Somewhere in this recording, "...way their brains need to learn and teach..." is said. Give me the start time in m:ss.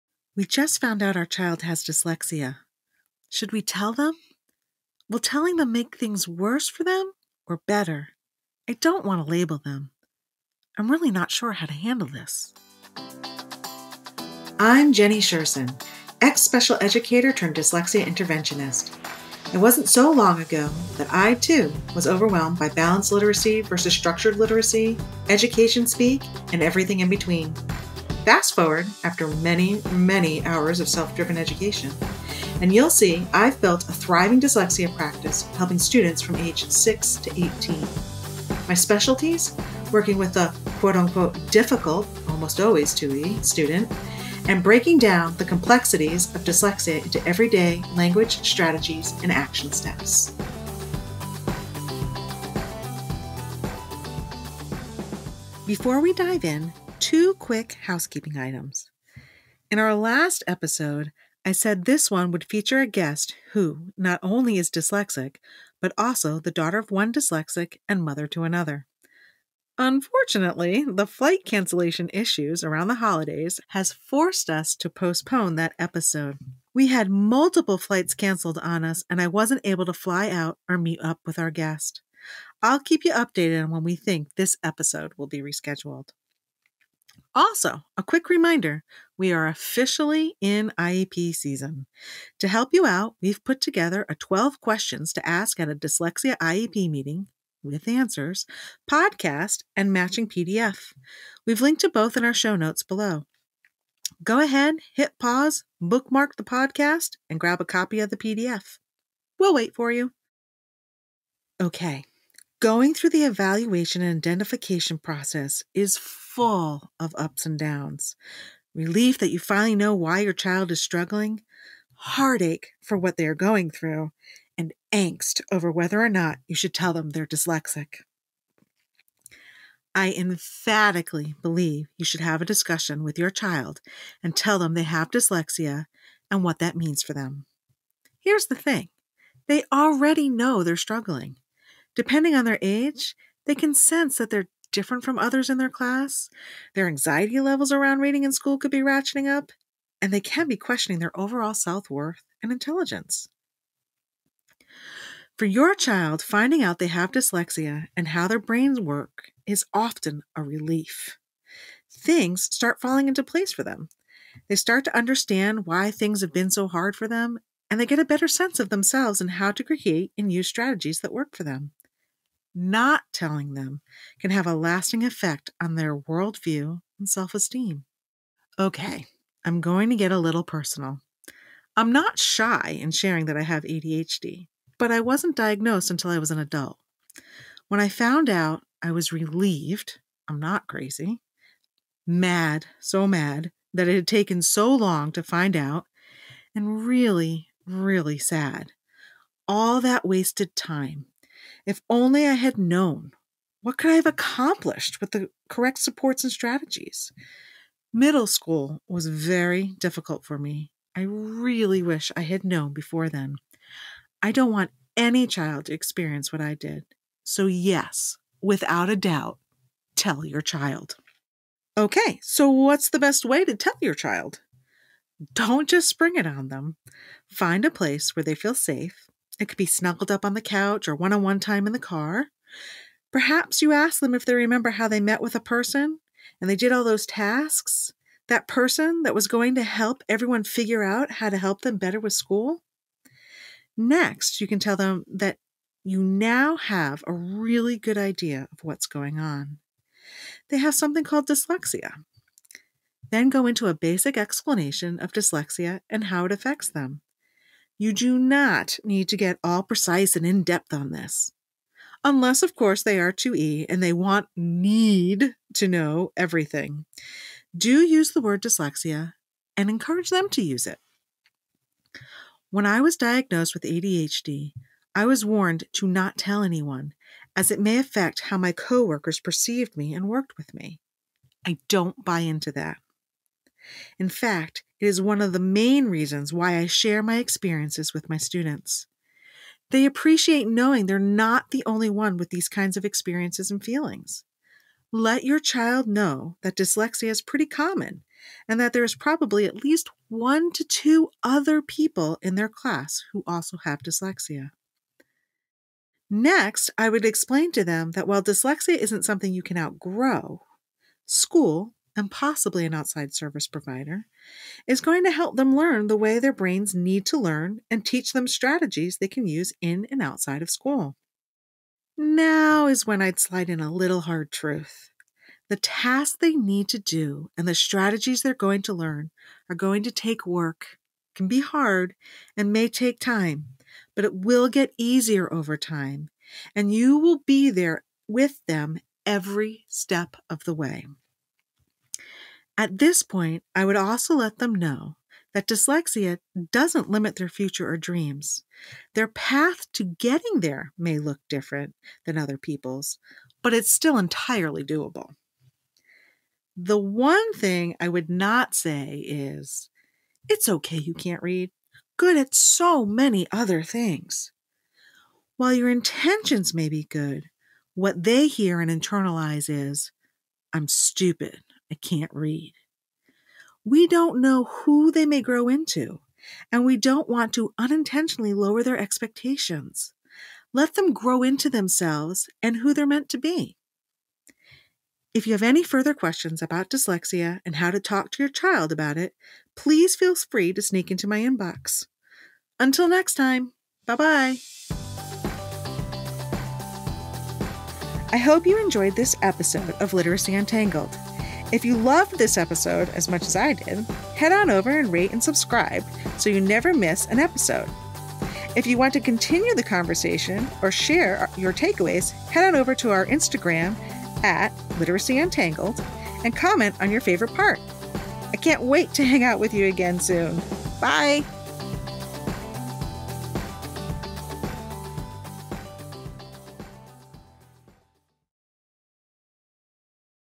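5:15.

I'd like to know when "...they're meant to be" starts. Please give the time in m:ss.
6:22.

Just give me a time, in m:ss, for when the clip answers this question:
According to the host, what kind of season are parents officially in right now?
1:30.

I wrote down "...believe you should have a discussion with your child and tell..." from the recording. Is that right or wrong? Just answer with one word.
right.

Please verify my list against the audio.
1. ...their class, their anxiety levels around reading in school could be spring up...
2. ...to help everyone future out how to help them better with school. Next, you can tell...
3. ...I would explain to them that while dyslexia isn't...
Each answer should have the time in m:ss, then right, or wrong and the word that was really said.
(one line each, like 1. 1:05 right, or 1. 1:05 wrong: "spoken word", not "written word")
1. 2:25 wrong: "ratcheting", not "spring"
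2. 3:59 wrong: "figure", not "future"
3. 5:06 right.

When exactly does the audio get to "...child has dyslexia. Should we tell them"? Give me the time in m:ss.
0:01.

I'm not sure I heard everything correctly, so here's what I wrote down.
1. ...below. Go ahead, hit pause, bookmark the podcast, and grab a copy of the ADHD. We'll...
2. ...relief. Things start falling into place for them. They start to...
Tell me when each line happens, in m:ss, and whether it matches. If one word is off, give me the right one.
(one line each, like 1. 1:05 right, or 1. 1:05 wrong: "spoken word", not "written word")
1. 1:42 wrong: "PDF", not "ADHD"
2. 2:40 right.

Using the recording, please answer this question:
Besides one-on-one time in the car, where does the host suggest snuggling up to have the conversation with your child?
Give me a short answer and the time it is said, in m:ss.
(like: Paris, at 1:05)
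the couch, at 3:50.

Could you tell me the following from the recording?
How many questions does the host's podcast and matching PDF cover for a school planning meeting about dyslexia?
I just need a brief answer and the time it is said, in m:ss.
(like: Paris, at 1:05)
12, at 1:34.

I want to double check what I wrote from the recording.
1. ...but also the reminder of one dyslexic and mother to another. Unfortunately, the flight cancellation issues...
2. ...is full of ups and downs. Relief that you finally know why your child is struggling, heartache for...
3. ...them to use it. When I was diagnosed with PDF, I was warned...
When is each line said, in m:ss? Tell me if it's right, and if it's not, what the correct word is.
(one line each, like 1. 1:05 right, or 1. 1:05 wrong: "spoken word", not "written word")
1. 1:05 wrong: "daughter", not "reminder"
2. 1:55 right
3. 4:30 wrong: "ADHD", not "PDF".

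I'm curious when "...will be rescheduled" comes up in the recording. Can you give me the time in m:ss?
1:25.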